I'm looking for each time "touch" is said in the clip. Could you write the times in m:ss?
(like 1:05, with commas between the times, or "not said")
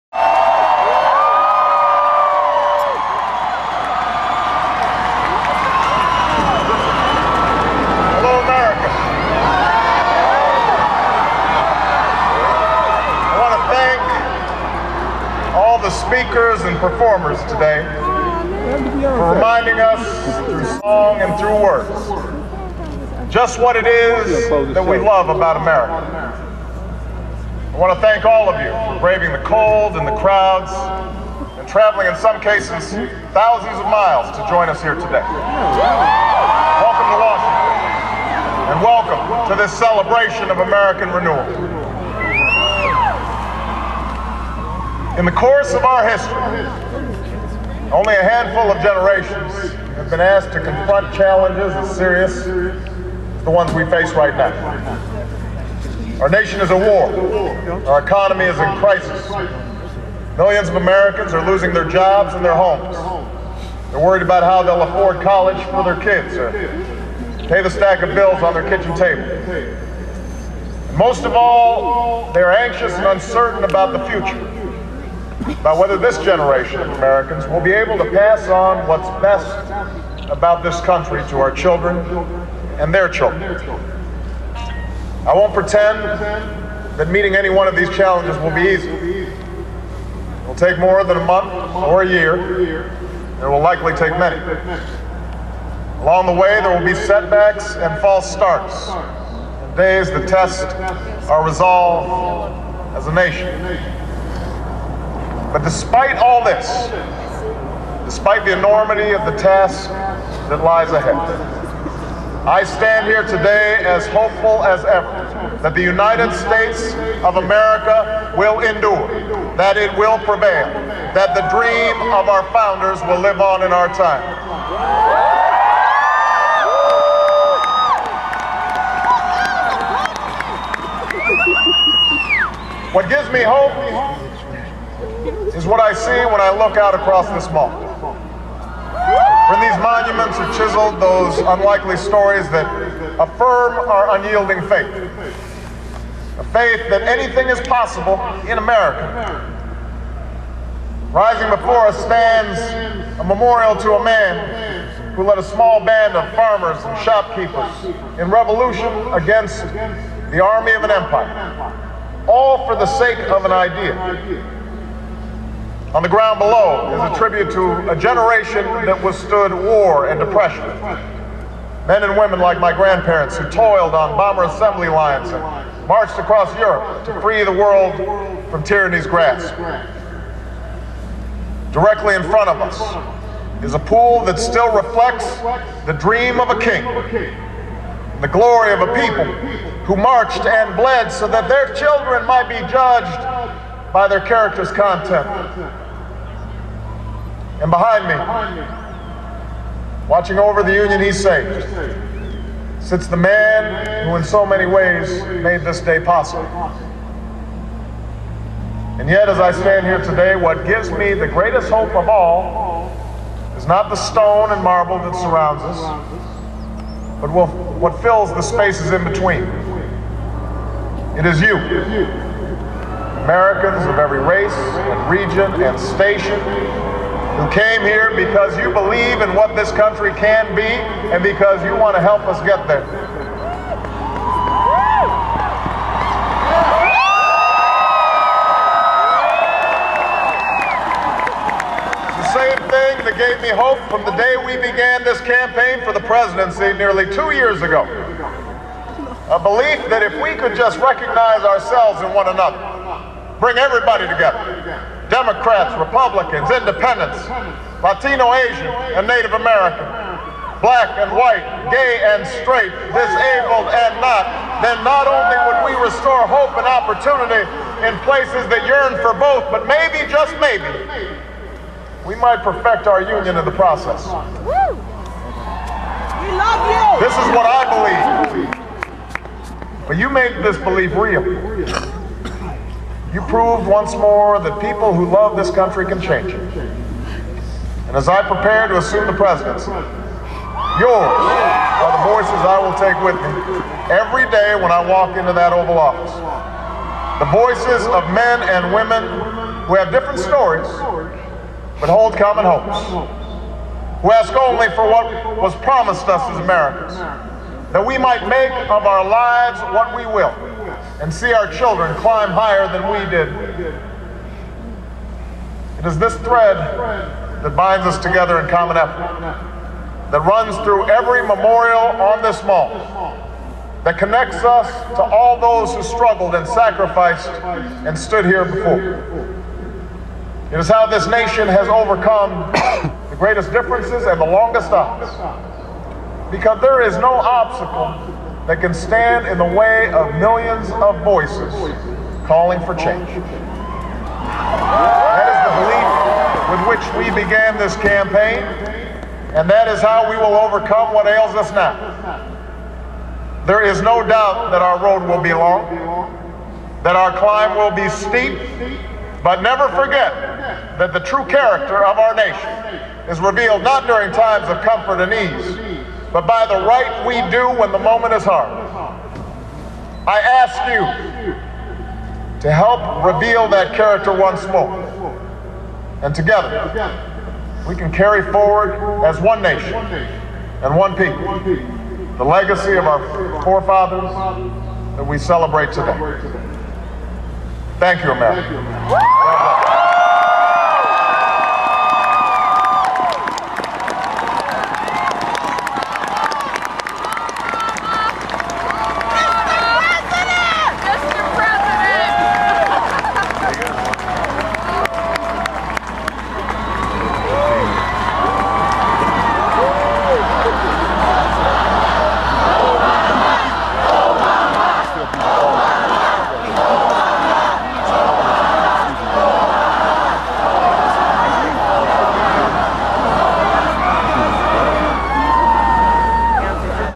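not said.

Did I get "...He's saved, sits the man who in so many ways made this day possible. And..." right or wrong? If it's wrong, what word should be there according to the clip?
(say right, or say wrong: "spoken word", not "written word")
right.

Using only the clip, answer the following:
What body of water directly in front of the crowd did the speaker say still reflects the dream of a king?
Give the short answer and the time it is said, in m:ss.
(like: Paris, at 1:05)
a pool, at 3:03.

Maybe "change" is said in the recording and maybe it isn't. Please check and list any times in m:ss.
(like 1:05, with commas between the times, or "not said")
4:46, 5:42.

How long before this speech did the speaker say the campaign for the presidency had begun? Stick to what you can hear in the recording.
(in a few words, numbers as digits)
nearly two years ago.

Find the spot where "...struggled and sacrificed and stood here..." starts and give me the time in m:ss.
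5:25.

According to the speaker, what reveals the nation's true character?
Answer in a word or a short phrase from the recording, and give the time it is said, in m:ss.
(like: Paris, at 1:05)
the right we do, at 6:06.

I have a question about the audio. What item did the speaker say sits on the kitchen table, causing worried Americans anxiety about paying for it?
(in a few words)
stack of bills.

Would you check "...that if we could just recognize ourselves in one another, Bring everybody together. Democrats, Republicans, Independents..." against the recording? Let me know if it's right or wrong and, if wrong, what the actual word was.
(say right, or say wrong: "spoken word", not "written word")
right.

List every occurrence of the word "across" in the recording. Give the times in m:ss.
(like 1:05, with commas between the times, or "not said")
2:16, 2:56.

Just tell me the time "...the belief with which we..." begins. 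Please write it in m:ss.
5:46.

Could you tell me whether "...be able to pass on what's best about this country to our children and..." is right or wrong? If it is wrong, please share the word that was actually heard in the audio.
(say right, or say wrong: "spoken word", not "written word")
right.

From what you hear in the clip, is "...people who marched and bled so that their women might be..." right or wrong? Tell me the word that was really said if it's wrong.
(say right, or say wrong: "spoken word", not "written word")
wrong: "children", not "women".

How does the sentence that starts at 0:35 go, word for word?
Welcome to Washington and welcome to this celebration of American renewal.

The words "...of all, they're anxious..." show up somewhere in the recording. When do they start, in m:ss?
1:11.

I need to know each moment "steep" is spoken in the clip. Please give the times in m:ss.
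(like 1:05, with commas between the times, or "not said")
5:57.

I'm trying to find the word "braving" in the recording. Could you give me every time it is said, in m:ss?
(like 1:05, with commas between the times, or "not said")
0:28.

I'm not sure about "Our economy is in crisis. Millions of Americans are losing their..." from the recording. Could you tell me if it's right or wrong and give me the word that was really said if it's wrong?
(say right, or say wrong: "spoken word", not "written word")
right.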